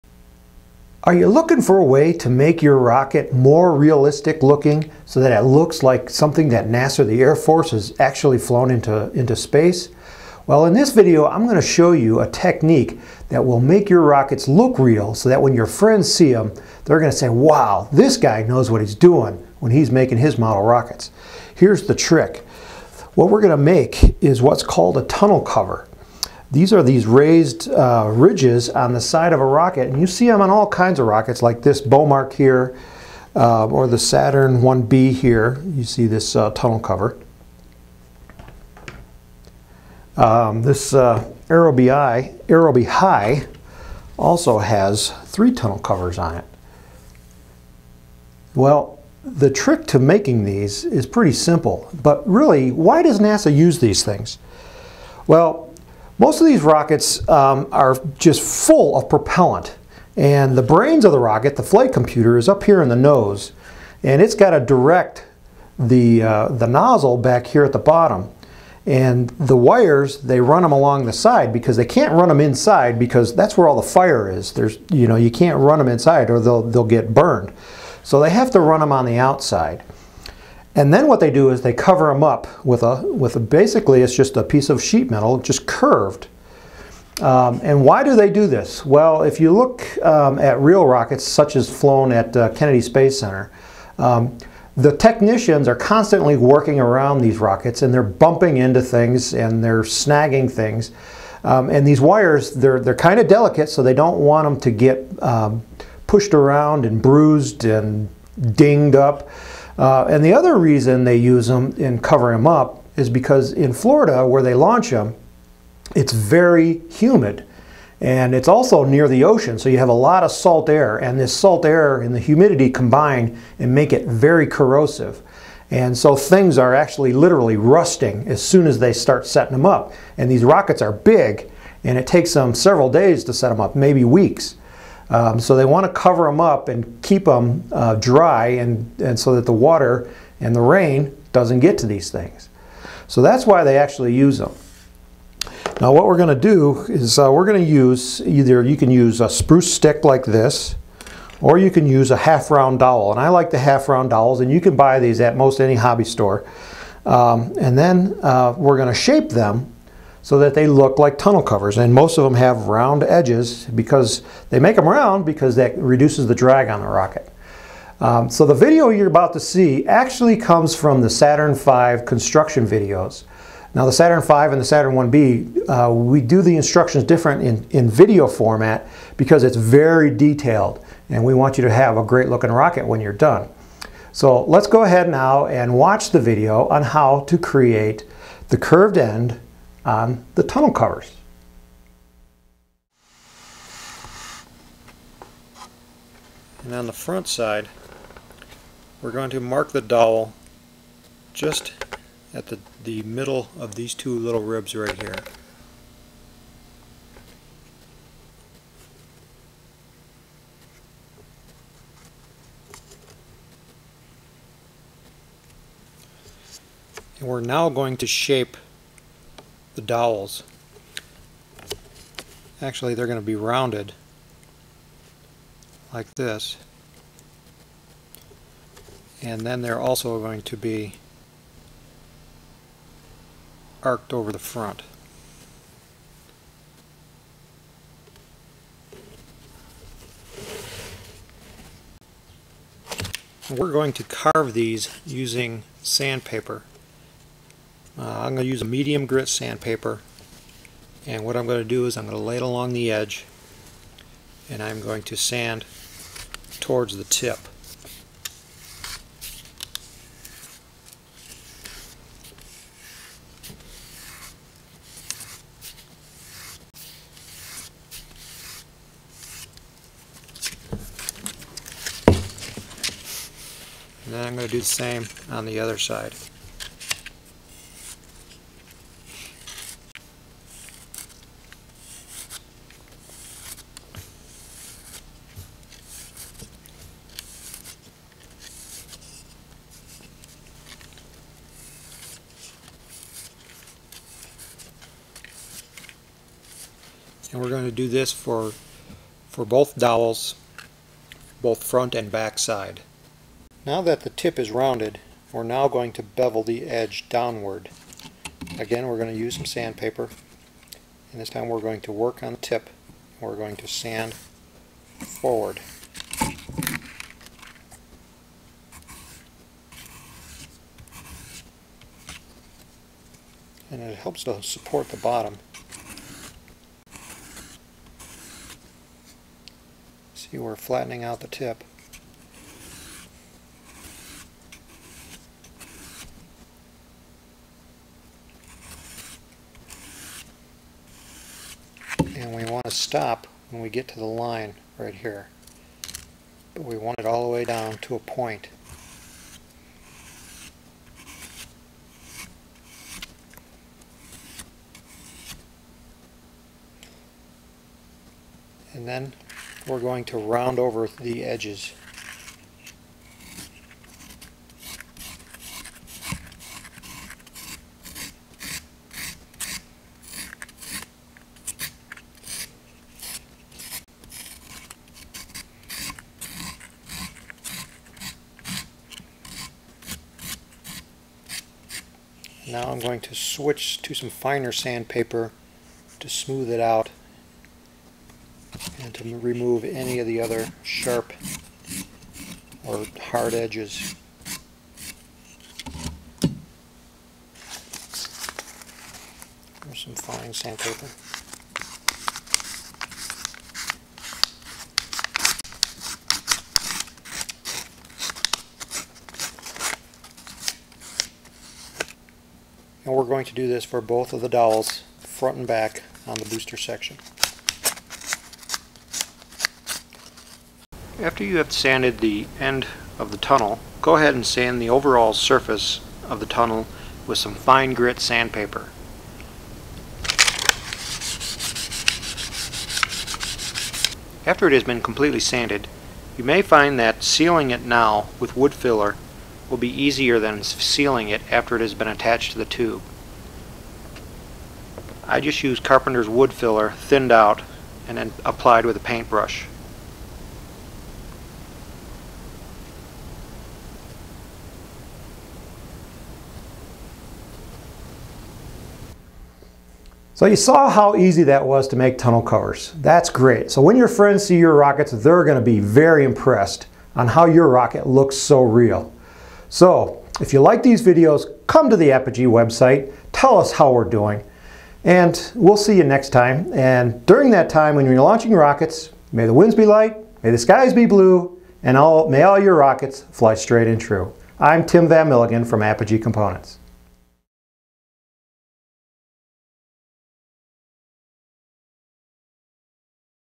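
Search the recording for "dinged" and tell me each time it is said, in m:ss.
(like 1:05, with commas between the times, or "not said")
1:48.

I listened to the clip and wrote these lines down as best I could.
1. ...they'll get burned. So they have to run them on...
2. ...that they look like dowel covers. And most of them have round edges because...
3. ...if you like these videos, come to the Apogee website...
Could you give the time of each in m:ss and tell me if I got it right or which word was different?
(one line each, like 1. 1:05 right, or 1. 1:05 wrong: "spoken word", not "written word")
1. 1:16 right
2. 2:40 wrong: "tunnel", not "dowel"
3. 7:50 right.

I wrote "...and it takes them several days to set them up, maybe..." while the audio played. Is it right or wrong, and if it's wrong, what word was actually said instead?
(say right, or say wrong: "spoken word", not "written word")
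right.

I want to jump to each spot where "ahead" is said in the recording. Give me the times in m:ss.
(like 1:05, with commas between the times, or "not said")
3:04, 7:03.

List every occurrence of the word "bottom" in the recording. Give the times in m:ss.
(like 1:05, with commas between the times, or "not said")
1:07, 5:24.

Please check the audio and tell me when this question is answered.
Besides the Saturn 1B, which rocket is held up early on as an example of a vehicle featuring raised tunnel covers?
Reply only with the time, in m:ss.
0:31.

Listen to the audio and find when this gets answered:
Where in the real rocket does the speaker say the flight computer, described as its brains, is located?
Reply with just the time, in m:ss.
1:02.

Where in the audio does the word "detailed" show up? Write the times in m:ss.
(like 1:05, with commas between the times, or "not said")
3:00.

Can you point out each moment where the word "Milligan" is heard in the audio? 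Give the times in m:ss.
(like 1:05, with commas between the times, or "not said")
8:05.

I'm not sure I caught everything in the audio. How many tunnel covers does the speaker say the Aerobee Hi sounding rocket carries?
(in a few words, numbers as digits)
3.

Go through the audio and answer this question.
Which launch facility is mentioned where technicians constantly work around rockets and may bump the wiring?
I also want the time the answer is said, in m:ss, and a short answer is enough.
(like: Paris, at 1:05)
Kennedy Space Center, at 1:32.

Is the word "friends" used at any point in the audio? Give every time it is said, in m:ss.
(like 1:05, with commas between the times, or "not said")
0:15, 7:43.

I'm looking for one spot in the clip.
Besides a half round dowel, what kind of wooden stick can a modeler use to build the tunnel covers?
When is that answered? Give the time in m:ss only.
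2:29.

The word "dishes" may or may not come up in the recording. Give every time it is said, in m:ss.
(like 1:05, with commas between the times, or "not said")
not said.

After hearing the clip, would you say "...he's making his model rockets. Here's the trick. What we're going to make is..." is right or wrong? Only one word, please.
right.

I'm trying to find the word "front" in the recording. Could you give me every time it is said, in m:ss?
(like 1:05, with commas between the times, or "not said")
3:16, 3:54, 5:01, 6:54.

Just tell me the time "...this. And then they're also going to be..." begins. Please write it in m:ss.
3:46.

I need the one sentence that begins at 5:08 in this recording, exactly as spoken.
Again, we're going to use some sandpaper.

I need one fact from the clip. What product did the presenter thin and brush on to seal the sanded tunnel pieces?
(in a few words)
Carpenter's wood filler.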